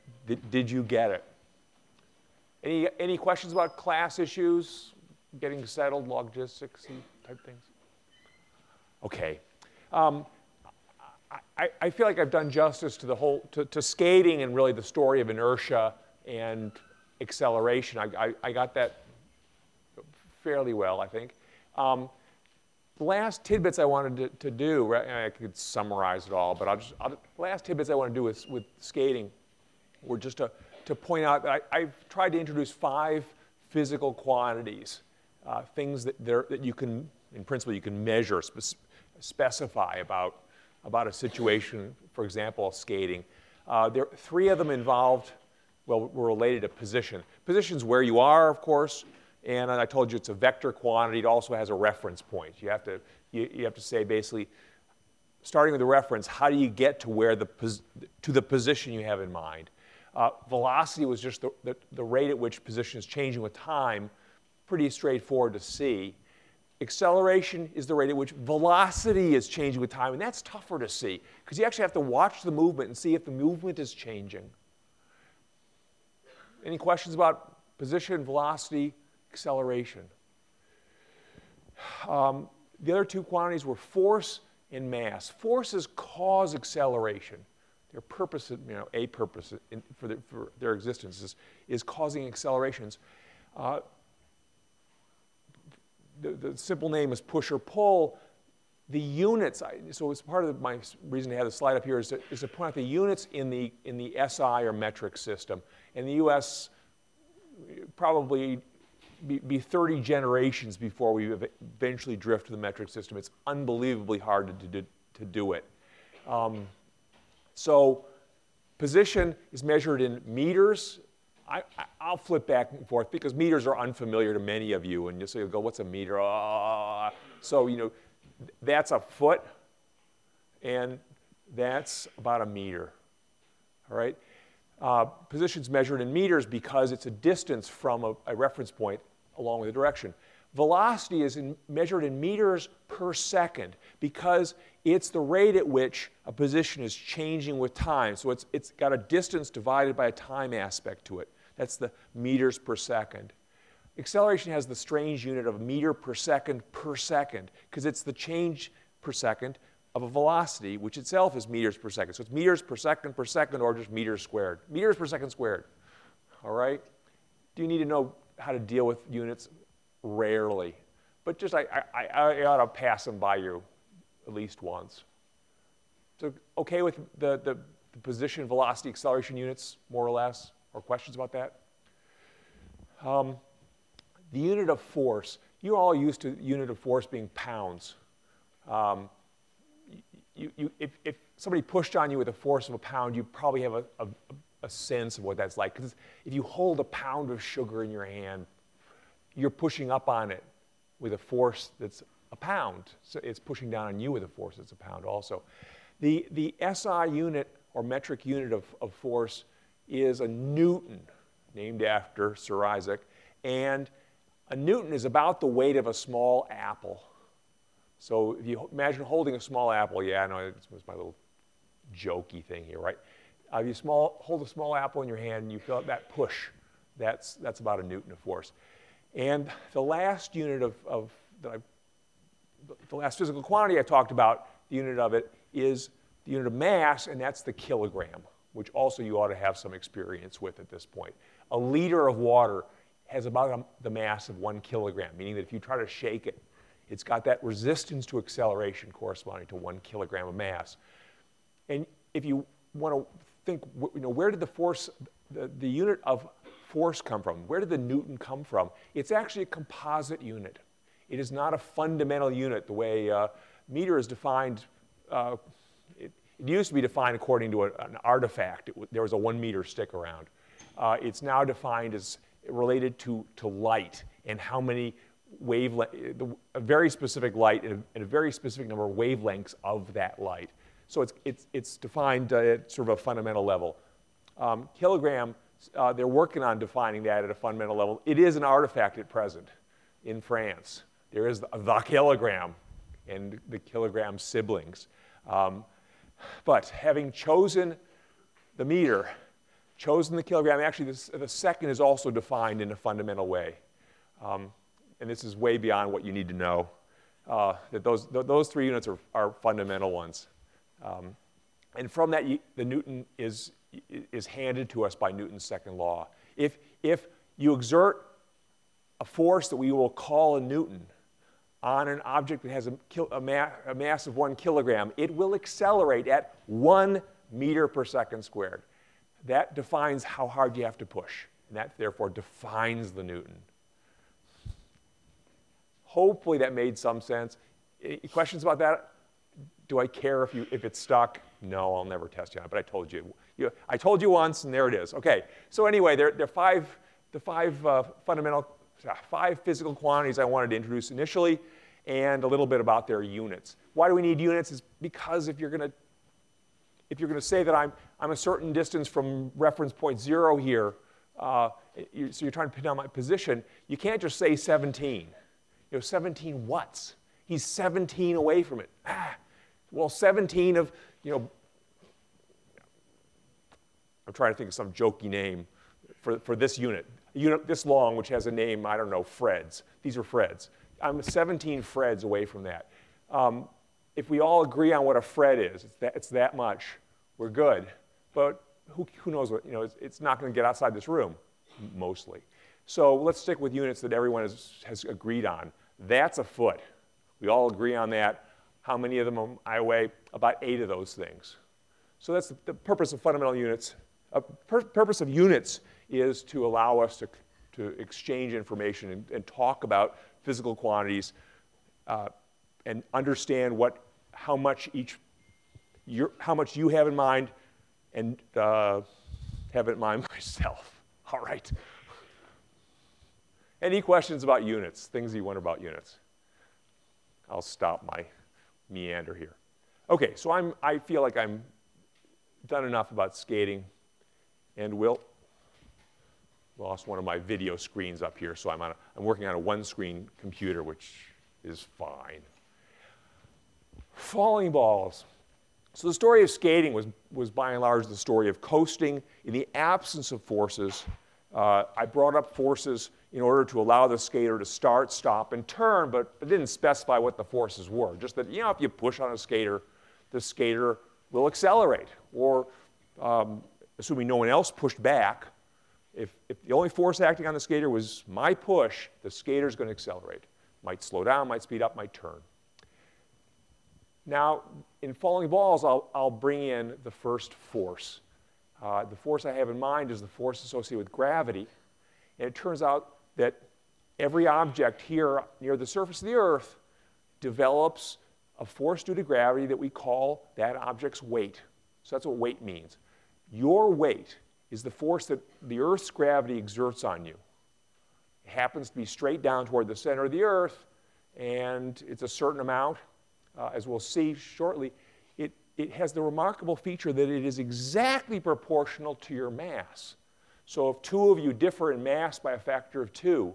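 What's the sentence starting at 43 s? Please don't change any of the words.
Uh, there, three of them involved, well, were related to position.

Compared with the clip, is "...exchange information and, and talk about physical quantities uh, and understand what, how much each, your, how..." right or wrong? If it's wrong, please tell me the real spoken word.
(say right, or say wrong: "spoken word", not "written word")
right.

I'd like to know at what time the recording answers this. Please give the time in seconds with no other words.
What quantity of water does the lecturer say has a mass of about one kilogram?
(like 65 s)
241 s.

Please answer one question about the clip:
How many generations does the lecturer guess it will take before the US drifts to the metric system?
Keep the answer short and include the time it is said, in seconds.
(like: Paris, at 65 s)
30, at 109 s.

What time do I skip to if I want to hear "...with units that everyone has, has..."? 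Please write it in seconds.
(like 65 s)
393 s.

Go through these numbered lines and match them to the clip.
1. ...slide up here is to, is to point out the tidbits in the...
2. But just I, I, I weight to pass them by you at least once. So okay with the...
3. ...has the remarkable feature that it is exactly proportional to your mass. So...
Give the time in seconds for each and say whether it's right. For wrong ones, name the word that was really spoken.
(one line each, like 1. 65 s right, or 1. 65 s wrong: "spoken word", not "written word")
1. 101 s wrong: "units", not "tidbits"
2. 171 s wrong: "ought", not "weight"
3. 505 s right.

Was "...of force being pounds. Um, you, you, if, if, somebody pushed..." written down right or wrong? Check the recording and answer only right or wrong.
right.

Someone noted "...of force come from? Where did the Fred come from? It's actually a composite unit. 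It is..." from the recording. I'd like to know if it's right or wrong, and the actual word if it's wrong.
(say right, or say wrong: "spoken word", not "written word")
wrong: "Newton", not "Fred".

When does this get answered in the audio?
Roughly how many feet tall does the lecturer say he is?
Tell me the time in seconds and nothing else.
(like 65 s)
400 s.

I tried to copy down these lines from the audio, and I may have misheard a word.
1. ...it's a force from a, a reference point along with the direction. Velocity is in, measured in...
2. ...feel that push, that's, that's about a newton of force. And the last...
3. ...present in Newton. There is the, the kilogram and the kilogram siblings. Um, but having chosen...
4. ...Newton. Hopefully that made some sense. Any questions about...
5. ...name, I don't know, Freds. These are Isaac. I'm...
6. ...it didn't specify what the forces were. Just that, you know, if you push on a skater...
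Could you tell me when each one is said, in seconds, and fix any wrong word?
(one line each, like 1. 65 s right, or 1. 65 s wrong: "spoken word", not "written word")
1. 136 s wrong: "distance", not "force"
2. 225 s right
3. 289 s wrong: "France", not "Newton"
4. 333 s right
5. 378 s wrong: "Freds", not "Isaac"
6. 456 s right.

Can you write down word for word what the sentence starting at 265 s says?
Uh, it, it, used to be defined according to a, an artifact.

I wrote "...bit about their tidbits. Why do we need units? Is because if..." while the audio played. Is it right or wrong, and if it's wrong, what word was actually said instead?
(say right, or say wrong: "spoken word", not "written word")
wrong: "units", not "tidbits".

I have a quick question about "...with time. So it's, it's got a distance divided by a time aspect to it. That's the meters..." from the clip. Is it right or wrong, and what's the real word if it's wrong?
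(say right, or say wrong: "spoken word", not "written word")
right.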